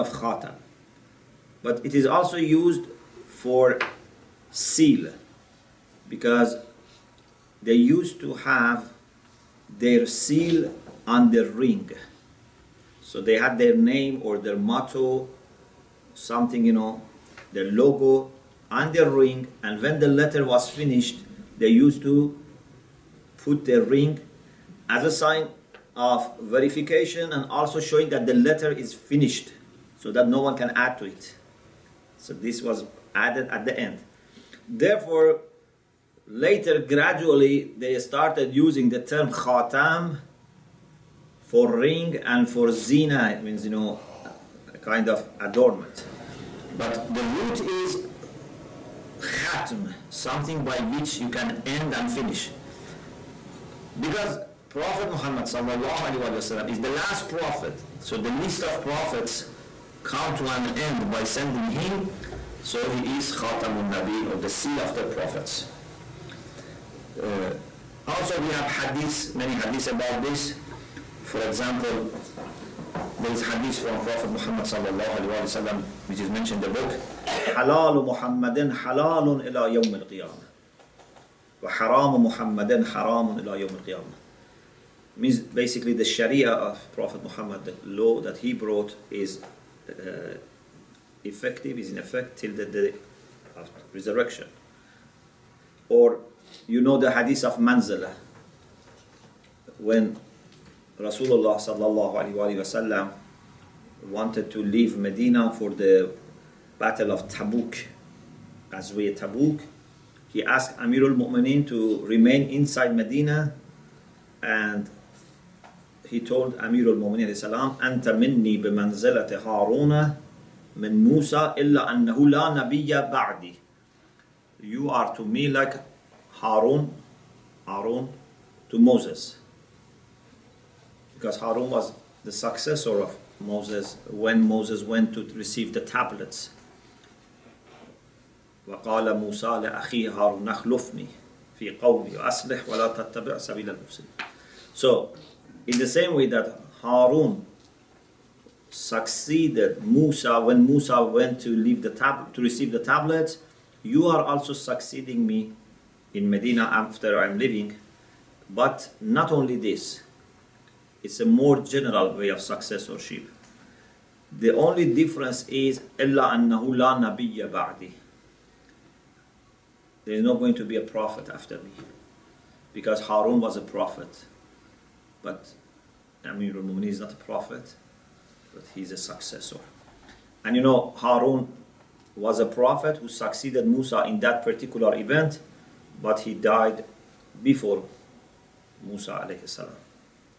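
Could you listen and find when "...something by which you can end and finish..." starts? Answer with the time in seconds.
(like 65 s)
50 s.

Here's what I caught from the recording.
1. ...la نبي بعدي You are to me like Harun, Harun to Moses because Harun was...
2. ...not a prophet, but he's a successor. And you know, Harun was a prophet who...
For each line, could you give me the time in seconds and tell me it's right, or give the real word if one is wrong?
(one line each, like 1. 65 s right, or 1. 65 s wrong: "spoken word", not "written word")
1. 122 s right
2. 176 s right.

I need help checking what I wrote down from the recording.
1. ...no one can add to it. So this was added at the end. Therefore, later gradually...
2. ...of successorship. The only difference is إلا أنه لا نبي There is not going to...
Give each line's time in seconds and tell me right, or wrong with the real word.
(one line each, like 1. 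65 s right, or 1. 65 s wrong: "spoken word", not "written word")
1. 30 s right
2. 162 s right.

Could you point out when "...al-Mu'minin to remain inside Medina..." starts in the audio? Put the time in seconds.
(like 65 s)
111 s.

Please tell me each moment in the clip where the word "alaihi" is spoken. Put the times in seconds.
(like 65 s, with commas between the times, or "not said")
55 s, 75 s, 102 s.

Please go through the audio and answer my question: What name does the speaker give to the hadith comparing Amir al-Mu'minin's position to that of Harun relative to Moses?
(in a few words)
hadith of Manzala.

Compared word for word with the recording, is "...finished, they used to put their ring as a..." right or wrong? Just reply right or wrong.
right.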